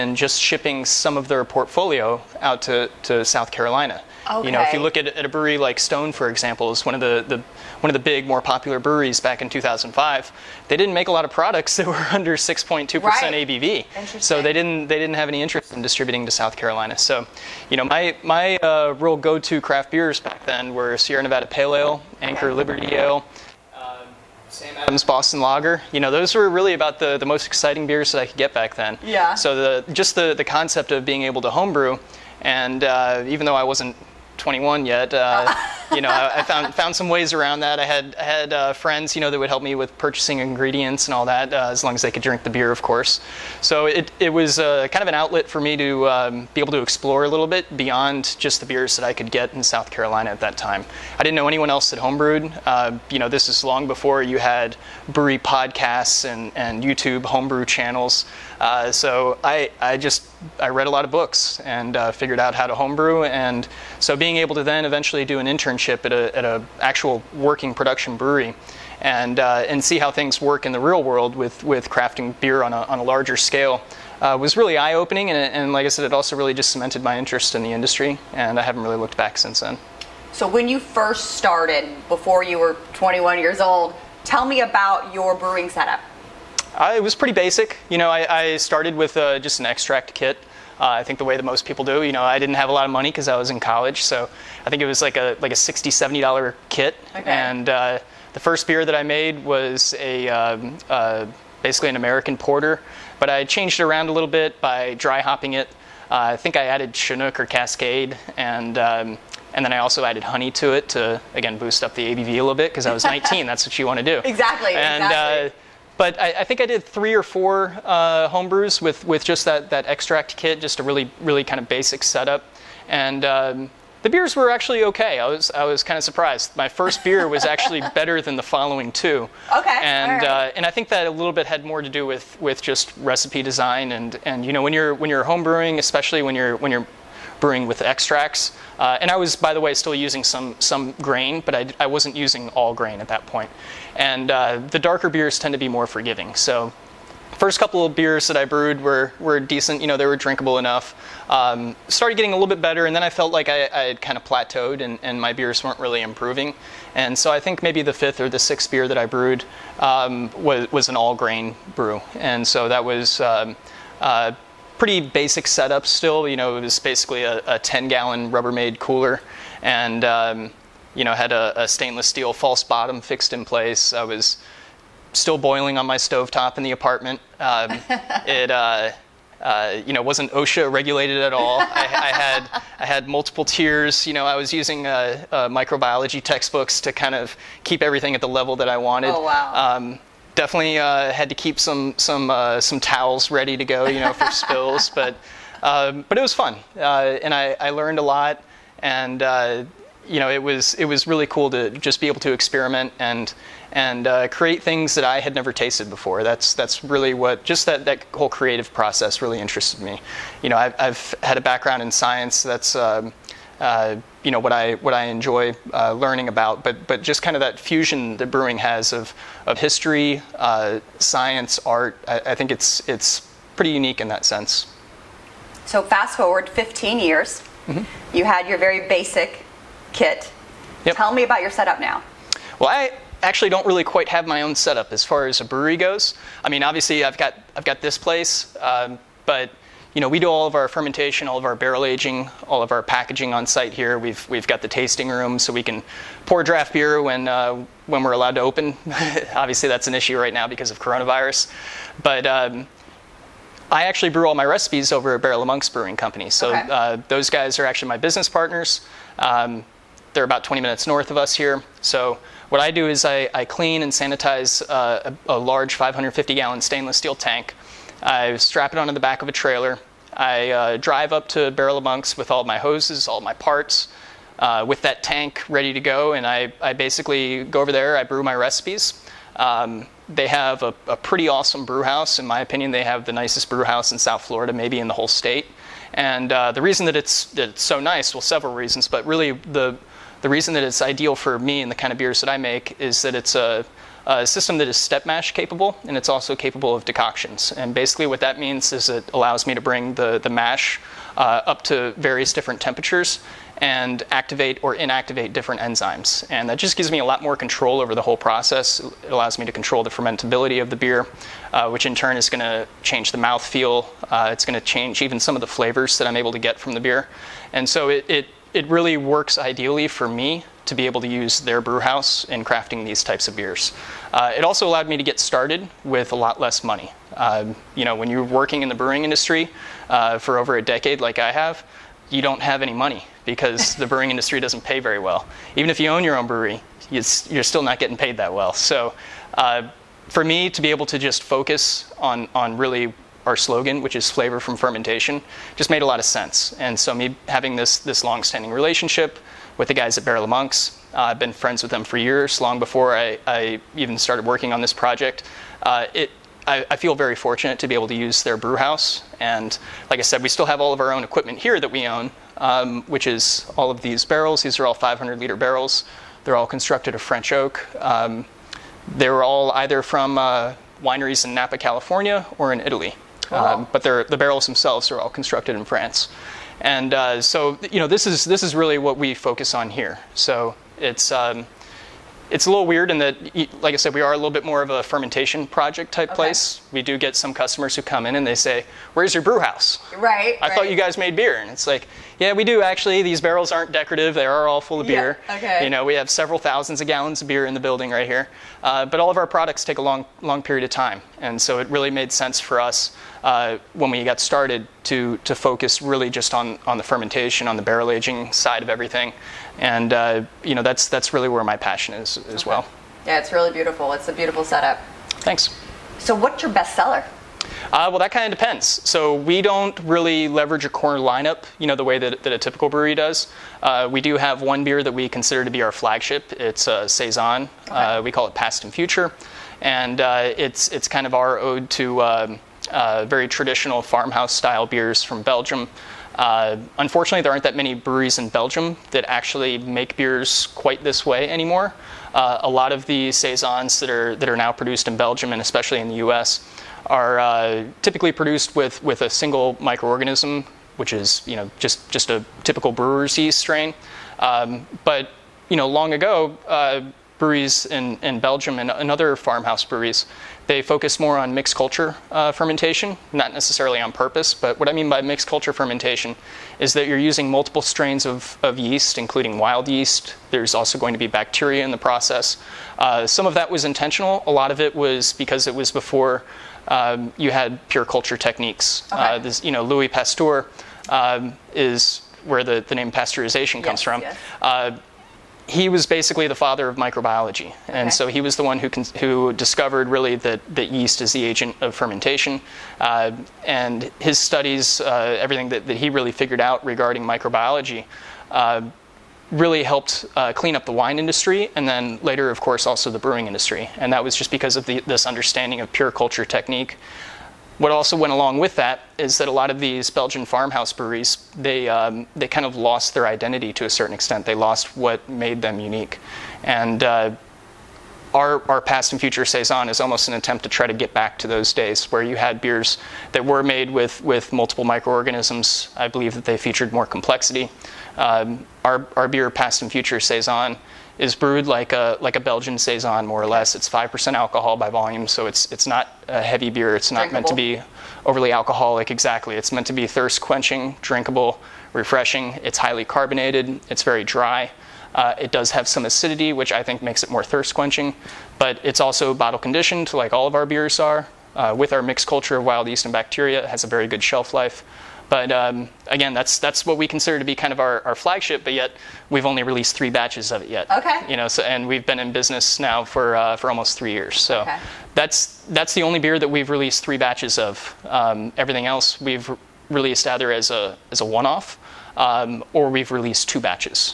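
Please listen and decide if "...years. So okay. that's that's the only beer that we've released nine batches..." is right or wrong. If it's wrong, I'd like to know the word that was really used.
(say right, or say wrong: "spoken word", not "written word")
wrong: "three", not "nine".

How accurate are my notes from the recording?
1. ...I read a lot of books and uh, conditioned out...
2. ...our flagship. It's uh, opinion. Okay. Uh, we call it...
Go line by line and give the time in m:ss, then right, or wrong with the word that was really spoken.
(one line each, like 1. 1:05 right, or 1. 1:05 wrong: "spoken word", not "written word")
1. 1:00 wrong: "figured", not "conditioned"
2. 7:05 wrong: "saison", not "opinion".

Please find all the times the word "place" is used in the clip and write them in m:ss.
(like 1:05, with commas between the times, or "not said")
2:53, 3:57, 6:26.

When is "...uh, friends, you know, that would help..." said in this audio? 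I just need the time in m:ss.
0:38.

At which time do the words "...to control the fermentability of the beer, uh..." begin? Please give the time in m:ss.
5:09.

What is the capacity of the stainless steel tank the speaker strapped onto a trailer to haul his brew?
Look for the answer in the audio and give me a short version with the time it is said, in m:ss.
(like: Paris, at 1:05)
550 gallons, at 4:25.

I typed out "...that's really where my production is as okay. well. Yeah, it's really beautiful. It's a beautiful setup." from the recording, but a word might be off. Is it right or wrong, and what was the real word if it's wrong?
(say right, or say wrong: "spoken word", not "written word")
wrong: "passion", not "production".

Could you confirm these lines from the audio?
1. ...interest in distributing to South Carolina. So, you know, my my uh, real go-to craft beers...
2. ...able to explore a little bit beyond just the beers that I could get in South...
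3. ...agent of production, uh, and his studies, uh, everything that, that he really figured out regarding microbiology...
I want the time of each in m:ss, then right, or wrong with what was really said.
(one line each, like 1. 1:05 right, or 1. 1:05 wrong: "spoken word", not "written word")
1. 0:15 right
2. 0:46 right
3. 8:11 wrong: "fermentation", not "production".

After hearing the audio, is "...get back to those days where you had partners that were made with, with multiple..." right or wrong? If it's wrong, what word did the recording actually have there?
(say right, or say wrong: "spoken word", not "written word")
wrong: "beers", not "partners".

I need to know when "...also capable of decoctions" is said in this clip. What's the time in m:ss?
4:56.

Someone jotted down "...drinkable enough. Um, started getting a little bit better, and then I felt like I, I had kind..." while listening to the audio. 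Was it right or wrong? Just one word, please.
right.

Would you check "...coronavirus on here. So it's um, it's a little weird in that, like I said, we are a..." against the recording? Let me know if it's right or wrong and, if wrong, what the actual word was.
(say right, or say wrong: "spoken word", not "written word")
wrong: "focus", not "coronavirus".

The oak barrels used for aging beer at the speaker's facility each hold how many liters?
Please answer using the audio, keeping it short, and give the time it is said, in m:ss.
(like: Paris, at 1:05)
500 liters, at 6:04.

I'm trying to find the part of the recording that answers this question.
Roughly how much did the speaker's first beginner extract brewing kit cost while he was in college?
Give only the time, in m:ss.
1:35.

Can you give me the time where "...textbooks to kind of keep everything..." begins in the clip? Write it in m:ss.
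3:06.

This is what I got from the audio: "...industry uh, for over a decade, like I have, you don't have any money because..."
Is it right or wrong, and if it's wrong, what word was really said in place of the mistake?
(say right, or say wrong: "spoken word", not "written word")
right.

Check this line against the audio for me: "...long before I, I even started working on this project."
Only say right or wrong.
right.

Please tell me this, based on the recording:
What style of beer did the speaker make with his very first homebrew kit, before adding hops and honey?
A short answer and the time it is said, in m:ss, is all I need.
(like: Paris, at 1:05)
American porter, at 1:41.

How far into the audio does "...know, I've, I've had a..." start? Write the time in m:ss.
3:30.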